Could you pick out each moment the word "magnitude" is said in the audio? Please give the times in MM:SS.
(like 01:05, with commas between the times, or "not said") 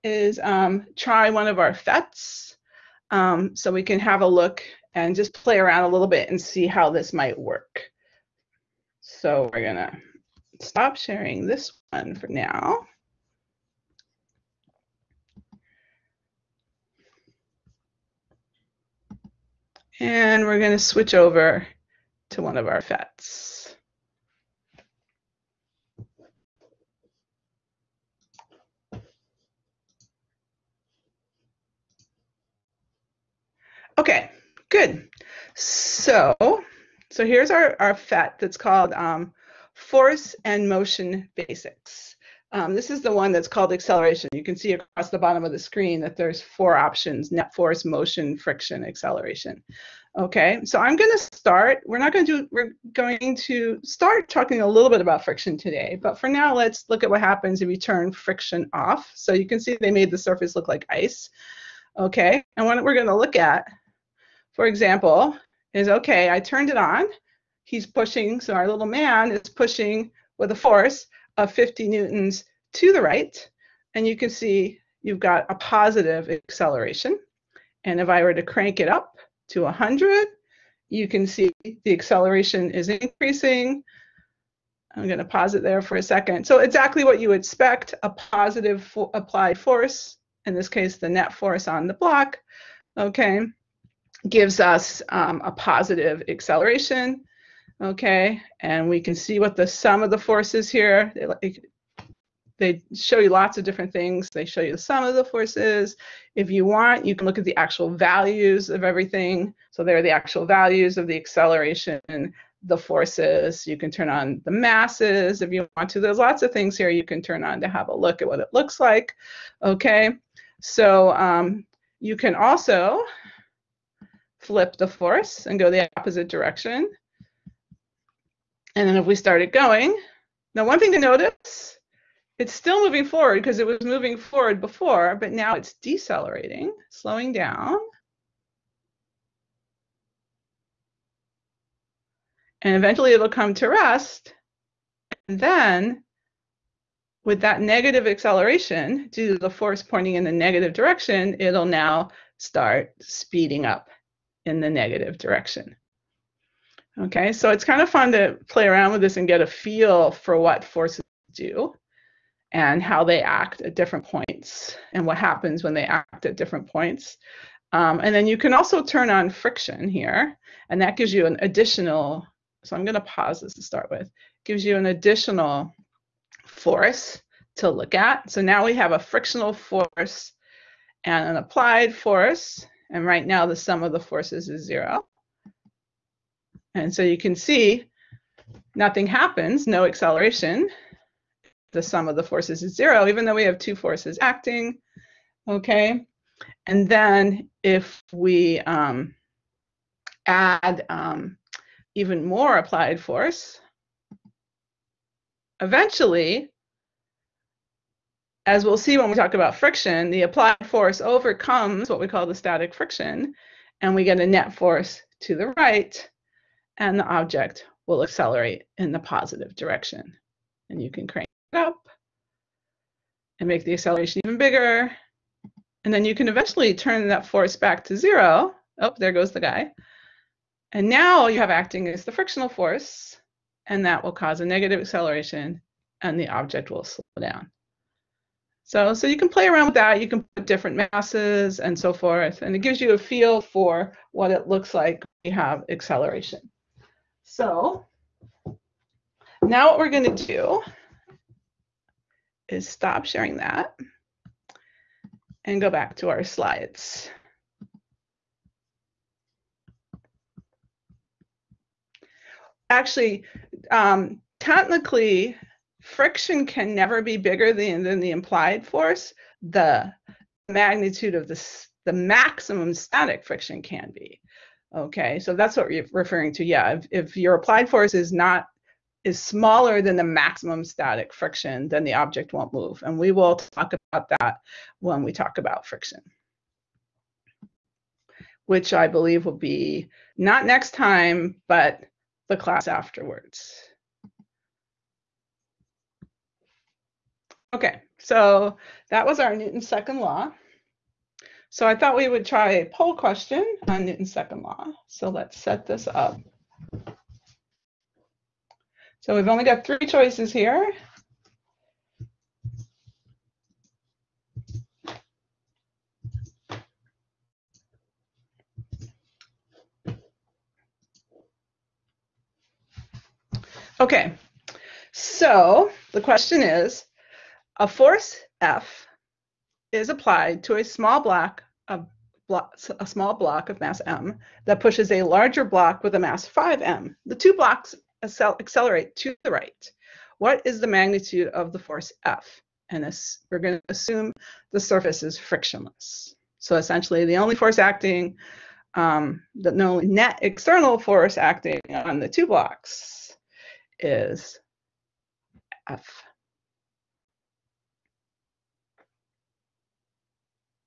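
04:30, 05:40.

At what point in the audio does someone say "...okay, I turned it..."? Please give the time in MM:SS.
01:05.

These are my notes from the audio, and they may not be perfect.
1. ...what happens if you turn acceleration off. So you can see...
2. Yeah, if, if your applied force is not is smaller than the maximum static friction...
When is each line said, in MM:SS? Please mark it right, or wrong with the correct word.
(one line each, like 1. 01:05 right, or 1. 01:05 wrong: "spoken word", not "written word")
1. 00:57 wrong: "friction", not "acceleration"
2. 04:36 right.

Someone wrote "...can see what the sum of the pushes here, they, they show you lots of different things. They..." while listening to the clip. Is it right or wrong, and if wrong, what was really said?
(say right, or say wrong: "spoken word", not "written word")
wrong: "forces", not "pushes".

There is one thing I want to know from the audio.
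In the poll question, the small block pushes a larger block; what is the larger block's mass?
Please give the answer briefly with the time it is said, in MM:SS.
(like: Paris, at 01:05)
5m, at 05:36.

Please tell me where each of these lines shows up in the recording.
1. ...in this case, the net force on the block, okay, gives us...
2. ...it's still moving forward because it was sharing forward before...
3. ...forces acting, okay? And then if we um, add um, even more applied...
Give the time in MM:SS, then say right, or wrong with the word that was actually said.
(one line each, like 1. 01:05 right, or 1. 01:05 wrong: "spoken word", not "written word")
1. 01:30 right
2. 02:12 wrong: "moving", not "sharing"
3. 03:13 right.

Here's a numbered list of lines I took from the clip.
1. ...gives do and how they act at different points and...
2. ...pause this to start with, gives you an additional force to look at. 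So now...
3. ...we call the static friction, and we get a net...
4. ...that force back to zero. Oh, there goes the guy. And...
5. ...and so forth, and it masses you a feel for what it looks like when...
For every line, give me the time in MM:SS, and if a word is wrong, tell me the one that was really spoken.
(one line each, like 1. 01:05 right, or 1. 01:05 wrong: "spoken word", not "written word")
1. 02:40 wrong: "forces", not "gives"
2. 02:53 right
3. 03:32 right
4. 03:47 right
5. 04:01 wrong: "gives", not "masses".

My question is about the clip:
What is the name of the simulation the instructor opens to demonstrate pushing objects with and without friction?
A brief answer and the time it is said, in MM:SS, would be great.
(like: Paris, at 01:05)
Force and Motion Basics, at 00:39.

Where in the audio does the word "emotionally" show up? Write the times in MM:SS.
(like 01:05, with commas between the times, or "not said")
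not said.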